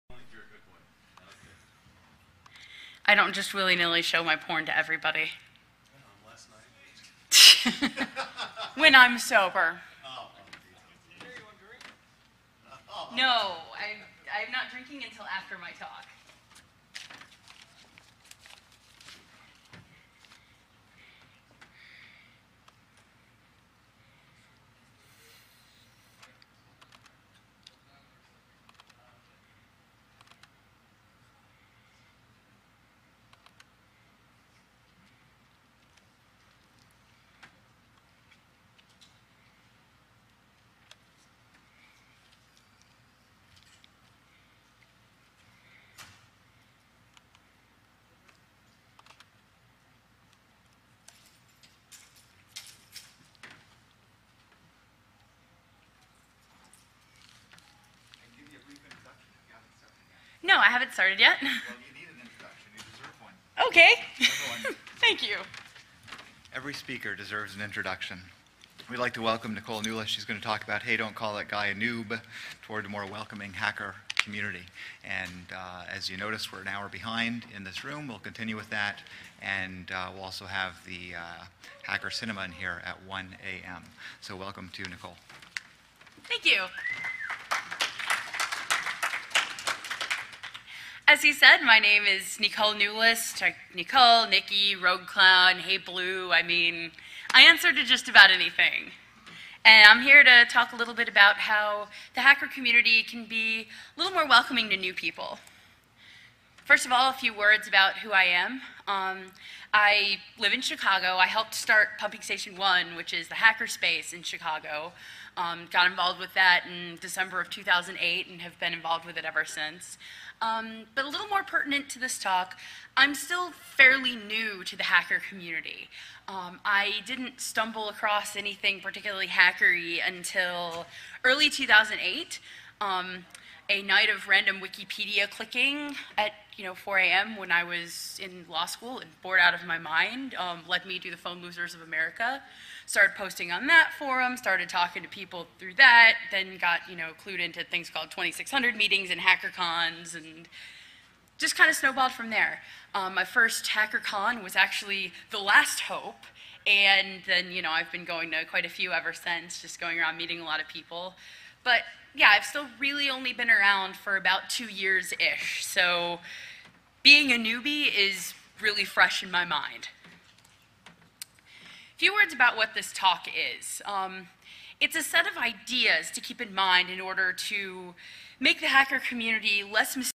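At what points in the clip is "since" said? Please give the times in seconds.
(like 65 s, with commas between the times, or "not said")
119 s, 159 s.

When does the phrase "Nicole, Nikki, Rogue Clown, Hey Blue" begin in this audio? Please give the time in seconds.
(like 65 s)
93 s.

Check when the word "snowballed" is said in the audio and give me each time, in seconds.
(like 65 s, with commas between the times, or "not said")
151 s.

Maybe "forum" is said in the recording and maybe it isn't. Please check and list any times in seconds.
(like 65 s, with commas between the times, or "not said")
143 s.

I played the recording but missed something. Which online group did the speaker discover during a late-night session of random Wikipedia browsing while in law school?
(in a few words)
Phone Losers of America.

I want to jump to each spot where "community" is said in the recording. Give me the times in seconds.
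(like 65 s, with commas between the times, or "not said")
74 s, 102 s, 125 s, 178 s.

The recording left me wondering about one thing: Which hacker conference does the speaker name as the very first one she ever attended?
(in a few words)
The Last HOPE.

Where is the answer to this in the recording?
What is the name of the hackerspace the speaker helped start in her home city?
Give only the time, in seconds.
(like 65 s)
111 s.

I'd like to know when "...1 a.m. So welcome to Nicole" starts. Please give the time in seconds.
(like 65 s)
83 s.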